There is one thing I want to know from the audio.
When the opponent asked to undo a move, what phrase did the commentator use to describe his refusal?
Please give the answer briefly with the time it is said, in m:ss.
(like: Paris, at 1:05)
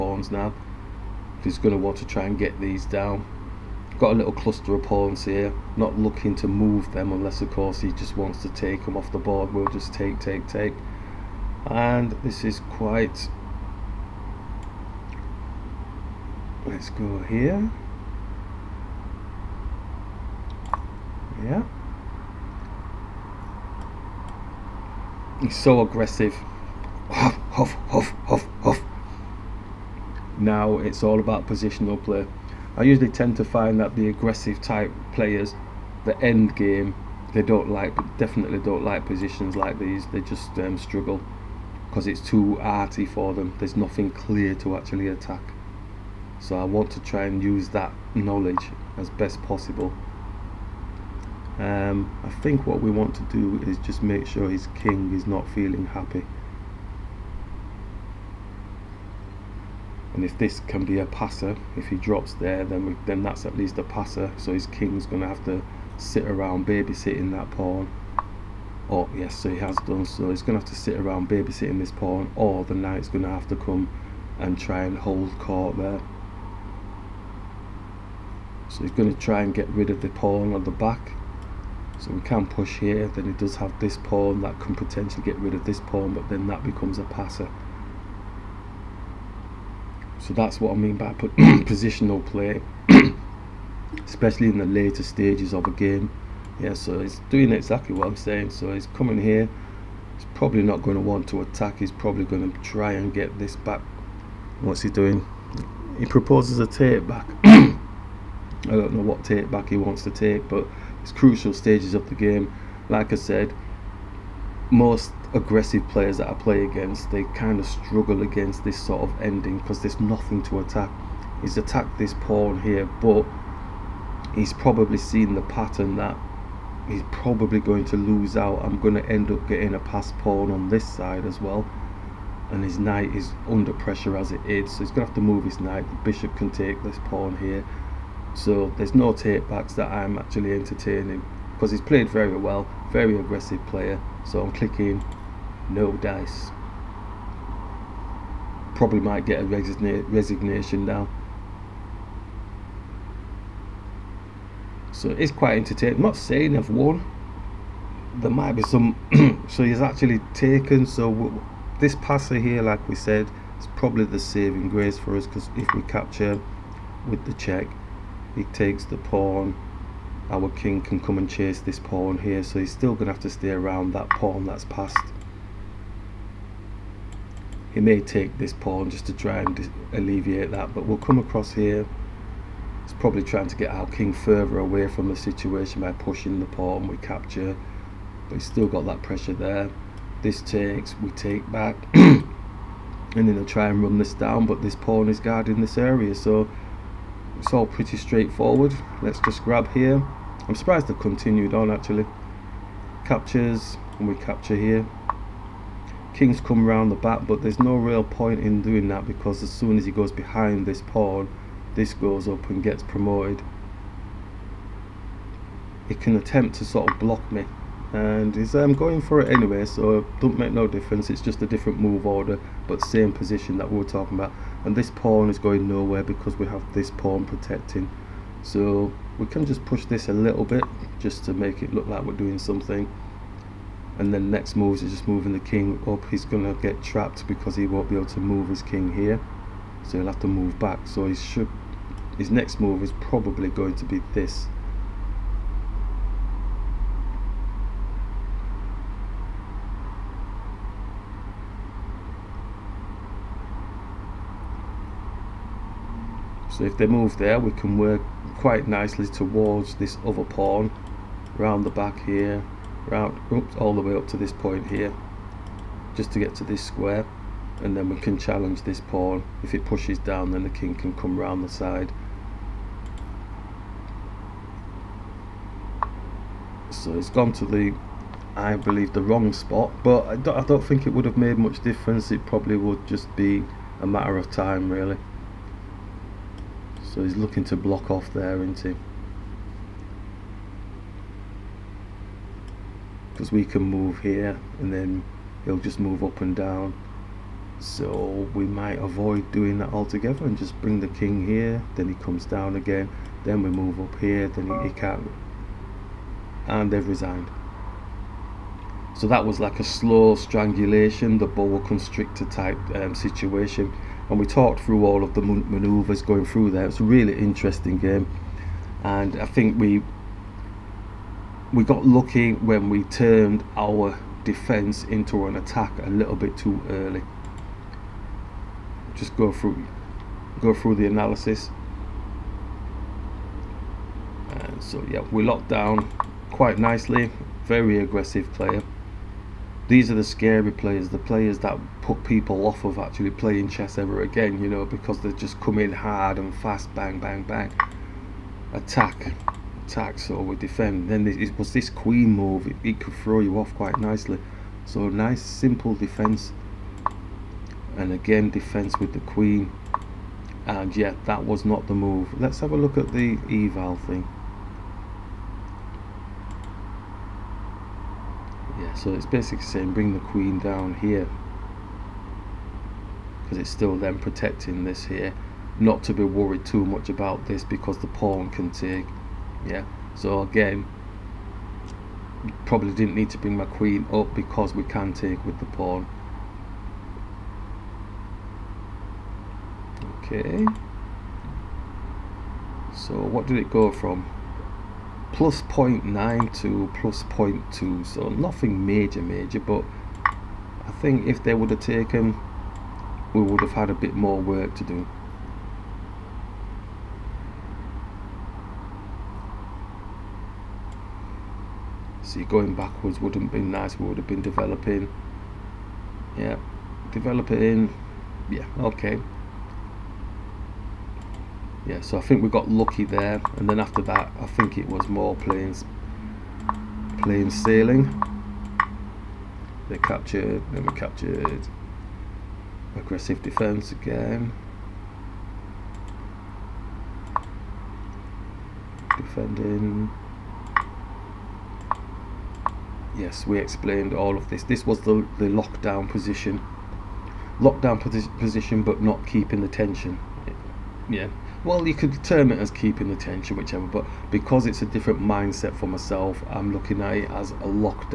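no dice, at 2:25.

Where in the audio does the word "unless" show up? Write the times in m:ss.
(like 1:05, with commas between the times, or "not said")
0:07.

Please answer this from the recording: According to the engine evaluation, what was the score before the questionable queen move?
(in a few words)
+0.92.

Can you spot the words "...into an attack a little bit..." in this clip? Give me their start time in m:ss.
5:24.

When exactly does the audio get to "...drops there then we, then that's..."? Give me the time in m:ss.
1:01.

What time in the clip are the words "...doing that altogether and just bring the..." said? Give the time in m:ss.
4:59.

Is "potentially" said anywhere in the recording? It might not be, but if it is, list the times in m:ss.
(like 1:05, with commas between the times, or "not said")
1:24.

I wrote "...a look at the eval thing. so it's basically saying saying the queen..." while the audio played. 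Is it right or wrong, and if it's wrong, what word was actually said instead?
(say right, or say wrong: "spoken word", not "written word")
wrong: "bring", not "saying".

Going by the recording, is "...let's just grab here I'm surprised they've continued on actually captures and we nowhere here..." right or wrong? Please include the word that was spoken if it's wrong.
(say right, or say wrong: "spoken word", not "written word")
wrong: "capture", not "nowhere".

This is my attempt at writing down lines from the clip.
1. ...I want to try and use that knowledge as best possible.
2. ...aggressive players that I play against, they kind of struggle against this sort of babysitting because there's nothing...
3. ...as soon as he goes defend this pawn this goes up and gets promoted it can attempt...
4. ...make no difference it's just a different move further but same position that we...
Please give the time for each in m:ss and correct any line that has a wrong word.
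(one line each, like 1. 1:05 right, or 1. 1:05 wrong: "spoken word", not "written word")
1. 0:46 right
2. 1:55 wrong: "ending", not "babysitting"
3. 3:29 wrong: "behind", not "defend"
4. 3:40 wrong: "order", not "further".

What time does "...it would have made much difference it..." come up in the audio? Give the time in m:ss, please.
4:40.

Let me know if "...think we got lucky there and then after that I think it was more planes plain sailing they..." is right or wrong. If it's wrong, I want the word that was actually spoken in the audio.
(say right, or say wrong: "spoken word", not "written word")
right.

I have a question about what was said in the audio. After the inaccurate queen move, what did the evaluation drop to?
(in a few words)
+0.2.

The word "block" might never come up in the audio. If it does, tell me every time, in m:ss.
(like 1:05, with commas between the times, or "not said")
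3:36, 4:47.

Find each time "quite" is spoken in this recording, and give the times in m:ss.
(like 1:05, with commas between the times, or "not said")
0:12, 2:35, 4:18, 5:36, 5:53.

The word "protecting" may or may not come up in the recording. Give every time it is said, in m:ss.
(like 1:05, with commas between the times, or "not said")
3:47, 6:13.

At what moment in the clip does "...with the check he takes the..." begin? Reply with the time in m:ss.
2:47.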